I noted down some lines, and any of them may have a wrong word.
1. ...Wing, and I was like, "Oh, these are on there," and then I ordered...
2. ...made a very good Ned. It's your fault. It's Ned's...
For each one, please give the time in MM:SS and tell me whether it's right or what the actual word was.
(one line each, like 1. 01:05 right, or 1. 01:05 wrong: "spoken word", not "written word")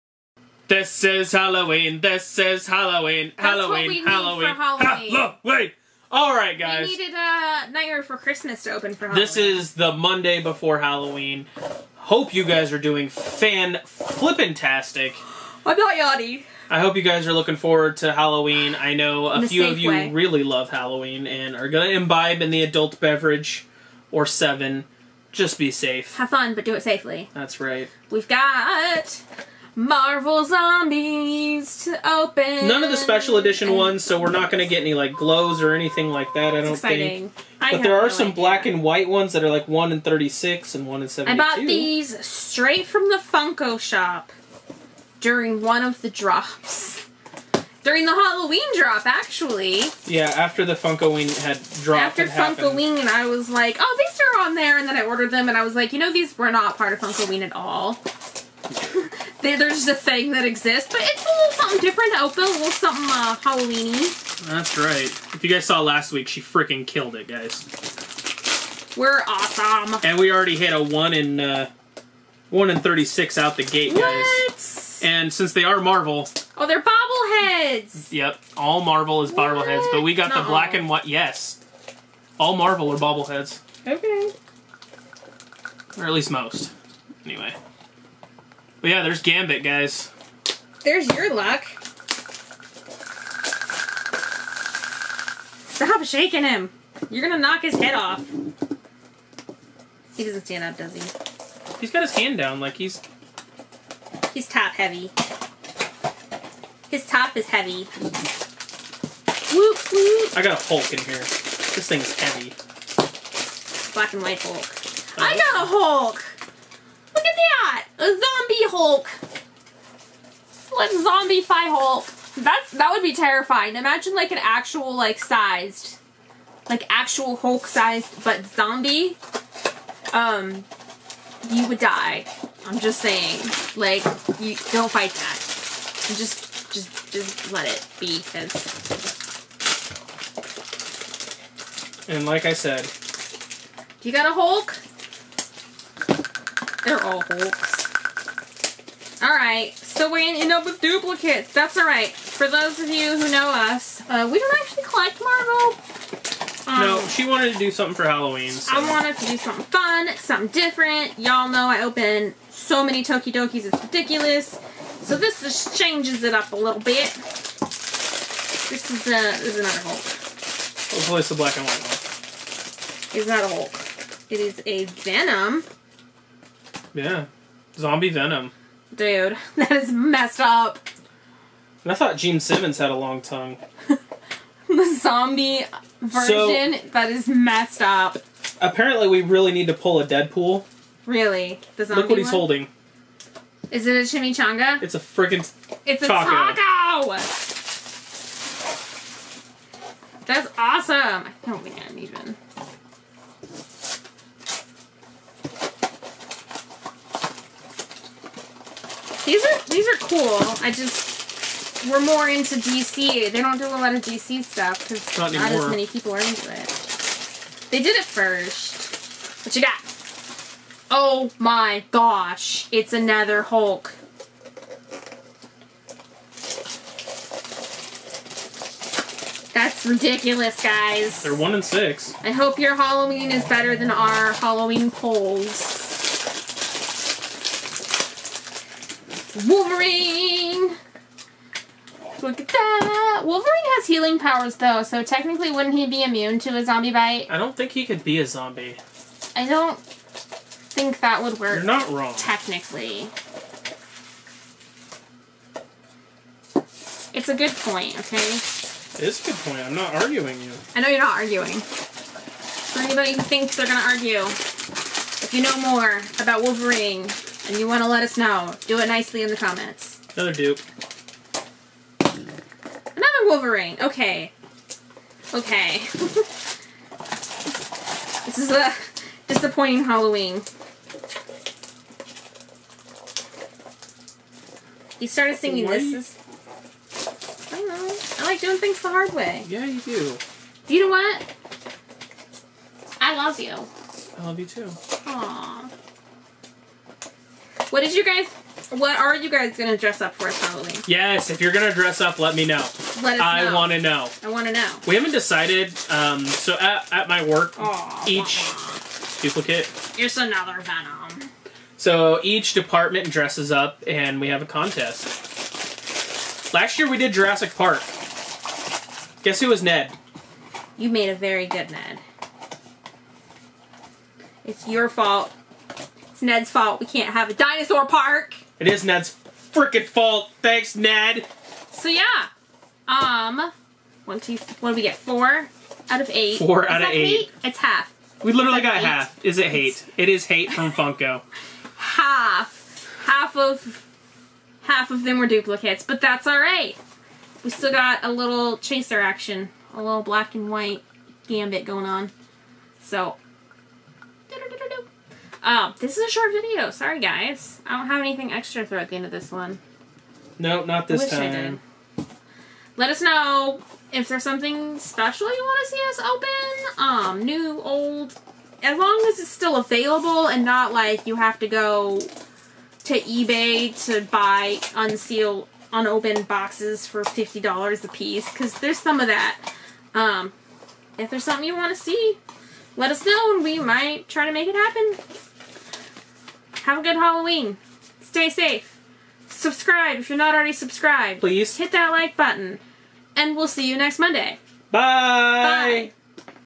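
1. 00:52 right
2. 05:20 right.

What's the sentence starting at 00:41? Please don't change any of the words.
I bought these straight from the Funko shop during one of the drops.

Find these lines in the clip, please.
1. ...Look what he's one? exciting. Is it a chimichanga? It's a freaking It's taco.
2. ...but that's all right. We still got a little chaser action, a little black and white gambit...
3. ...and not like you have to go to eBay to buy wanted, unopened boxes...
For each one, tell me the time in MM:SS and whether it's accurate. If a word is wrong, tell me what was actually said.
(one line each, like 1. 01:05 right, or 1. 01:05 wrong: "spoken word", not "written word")
1. 03:12 wrong: "holding", not "exciting"
2. 05:45 right
3. 06:10 wrong: "unsealed", not "wanted".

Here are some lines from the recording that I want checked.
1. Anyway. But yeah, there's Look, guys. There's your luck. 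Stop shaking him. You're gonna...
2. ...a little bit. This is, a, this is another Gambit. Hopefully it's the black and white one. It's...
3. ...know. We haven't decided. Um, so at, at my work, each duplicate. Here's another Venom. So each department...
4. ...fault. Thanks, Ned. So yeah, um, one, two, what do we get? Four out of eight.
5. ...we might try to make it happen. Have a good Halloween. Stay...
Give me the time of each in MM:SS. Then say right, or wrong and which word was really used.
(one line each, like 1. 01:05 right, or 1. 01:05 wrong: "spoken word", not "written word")
1. 01:27 wrong: "Gambit", not "Look"
2. 02:46 wrong: "Hulk", not "Gambit"
3. 05:04 right
4. 05:29 right
5. 06:23 right.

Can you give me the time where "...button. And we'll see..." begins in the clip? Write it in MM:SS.
06:32.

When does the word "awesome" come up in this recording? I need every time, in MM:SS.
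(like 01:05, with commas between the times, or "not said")
01:09, 03:20.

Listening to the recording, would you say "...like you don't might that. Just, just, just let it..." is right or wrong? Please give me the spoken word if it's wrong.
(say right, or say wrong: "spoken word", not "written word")
wrong: "fight", not "might".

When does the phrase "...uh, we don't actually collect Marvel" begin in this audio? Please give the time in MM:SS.
02:34.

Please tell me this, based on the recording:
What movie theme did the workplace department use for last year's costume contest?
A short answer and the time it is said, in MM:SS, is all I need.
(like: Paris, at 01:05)
Jurassic Park, at 05:17.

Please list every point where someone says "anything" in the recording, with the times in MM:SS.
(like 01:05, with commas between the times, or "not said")
00:35, 05:58.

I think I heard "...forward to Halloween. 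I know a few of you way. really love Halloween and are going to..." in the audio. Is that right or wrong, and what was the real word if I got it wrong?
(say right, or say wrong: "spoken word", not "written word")
right.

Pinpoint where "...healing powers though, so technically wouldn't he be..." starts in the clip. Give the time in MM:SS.
04:03.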